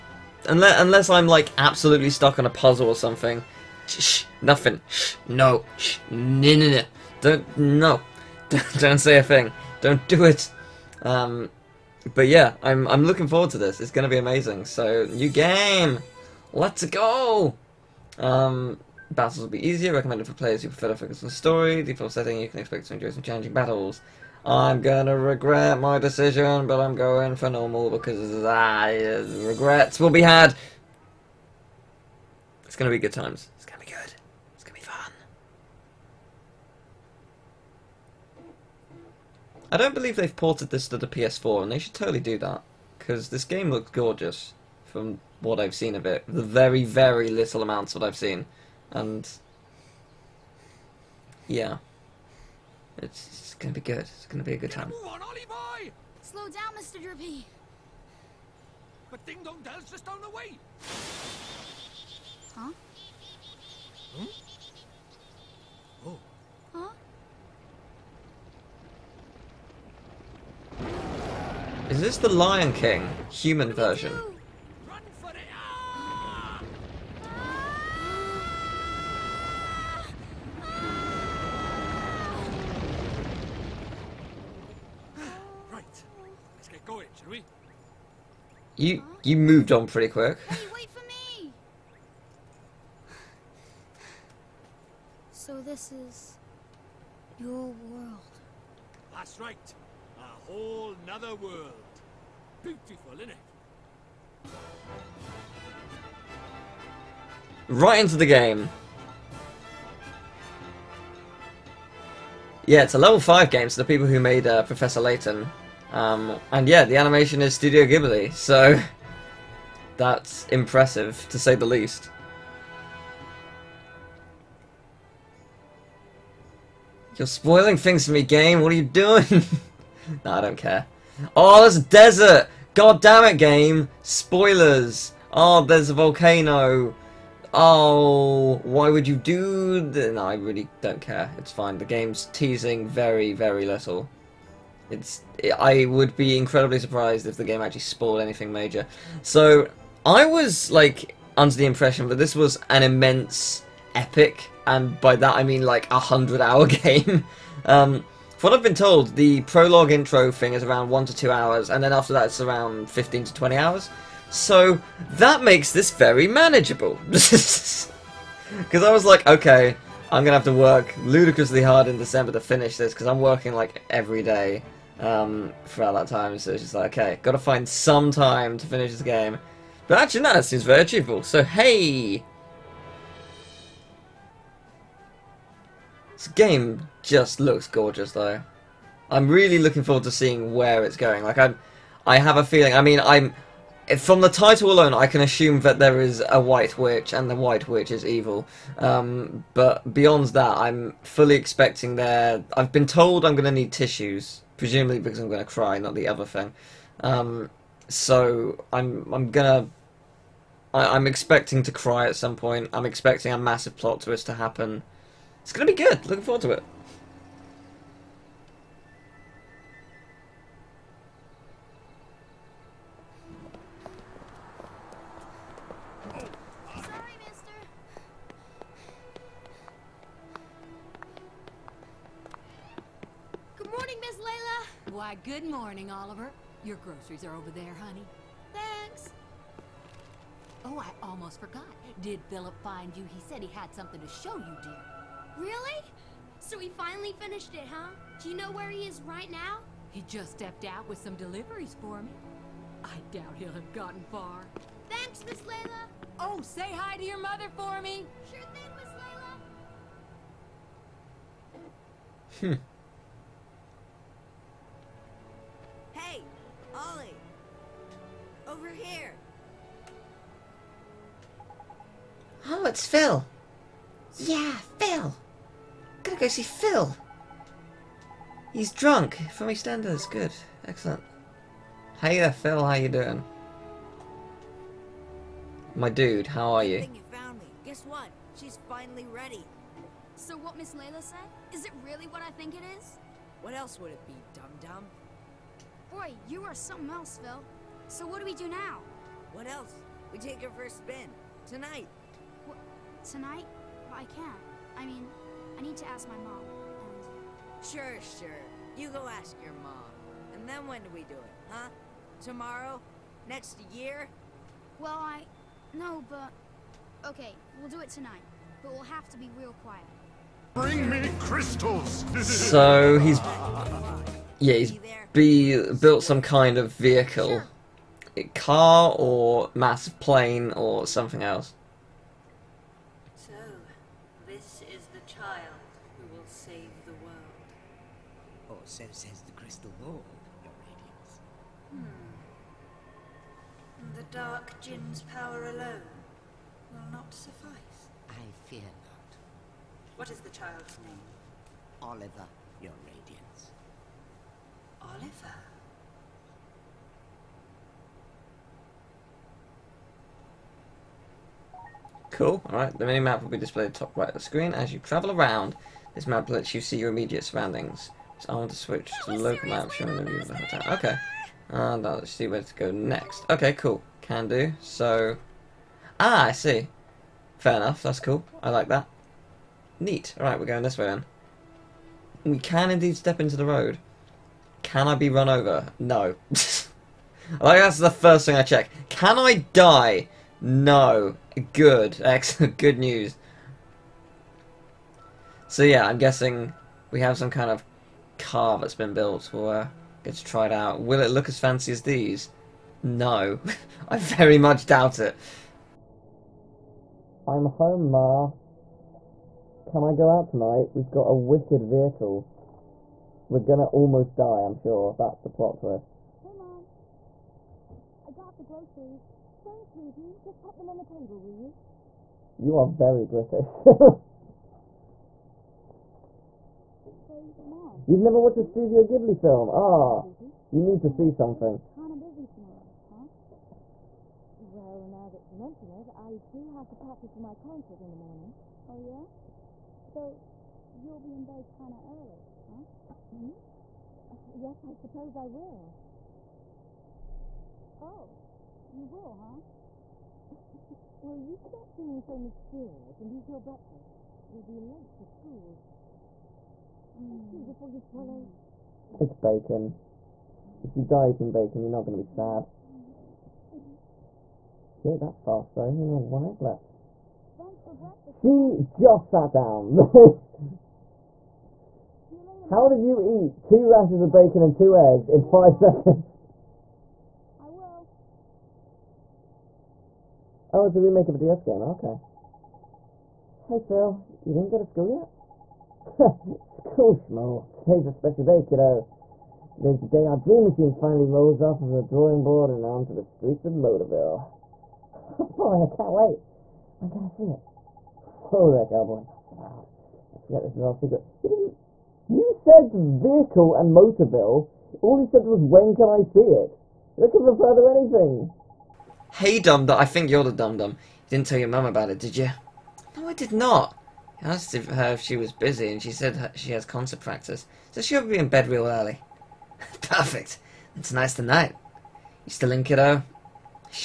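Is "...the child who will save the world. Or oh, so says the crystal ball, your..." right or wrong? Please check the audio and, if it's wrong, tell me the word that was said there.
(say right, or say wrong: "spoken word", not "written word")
right.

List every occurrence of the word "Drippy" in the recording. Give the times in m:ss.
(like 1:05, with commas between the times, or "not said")
0:57.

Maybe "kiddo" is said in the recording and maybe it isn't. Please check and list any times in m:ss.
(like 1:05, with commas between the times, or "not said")
8:08, 8:42.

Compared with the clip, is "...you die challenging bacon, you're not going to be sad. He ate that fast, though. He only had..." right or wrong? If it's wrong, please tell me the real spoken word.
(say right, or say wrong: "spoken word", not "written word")
wrong: "eating", not "challenging".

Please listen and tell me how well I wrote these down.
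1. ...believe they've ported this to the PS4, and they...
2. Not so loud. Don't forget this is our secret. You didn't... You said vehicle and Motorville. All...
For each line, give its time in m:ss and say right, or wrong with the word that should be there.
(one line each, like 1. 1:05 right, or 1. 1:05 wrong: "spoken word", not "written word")
1. 0:39 right
2. 8:19 right.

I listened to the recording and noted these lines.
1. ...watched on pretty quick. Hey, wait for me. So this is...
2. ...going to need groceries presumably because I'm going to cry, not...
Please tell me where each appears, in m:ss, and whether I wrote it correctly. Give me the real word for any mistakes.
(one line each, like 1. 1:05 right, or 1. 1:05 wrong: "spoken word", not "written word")
1. 1:29 wrong: "moved", not "watched"
2. 3:23 wrong: "tissues", not "groceries".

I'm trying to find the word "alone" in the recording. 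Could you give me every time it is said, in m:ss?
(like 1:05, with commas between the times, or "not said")
3:14, 5:45.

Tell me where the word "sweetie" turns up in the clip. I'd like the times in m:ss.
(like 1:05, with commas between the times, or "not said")
6:59.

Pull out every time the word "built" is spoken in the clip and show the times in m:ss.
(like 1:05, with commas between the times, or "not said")
5:25, 6:38.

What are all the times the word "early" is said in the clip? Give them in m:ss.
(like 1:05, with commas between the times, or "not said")
7:21, 8:38.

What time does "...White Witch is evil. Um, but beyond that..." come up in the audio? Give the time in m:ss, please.
3:17.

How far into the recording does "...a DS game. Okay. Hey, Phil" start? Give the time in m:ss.
8:01.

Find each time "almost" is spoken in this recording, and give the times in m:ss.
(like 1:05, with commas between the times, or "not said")
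4:01, 6:53.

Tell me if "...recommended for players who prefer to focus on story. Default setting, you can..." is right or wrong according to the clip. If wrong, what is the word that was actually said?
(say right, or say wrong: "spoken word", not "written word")
right.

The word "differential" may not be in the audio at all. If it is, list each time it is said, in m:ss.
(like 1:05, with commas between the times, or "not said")
not said.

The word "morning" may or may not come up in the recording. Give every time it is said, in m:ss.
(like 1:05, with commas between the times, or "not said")
3:55, 7:18.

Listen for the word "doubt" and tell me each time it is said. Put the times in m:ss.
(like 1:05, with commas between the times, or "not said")
4:13, 6:44.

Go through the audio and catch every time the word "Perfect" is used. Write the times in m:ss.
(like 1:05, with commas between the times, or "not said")
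8:39.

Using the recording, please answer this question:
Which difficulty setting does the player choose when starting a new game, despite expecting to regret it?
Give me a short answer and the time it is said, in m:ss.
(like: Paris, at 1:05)
Normal, at 0:27.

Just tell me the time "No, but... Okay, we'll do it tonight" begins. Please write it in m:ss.
5:15.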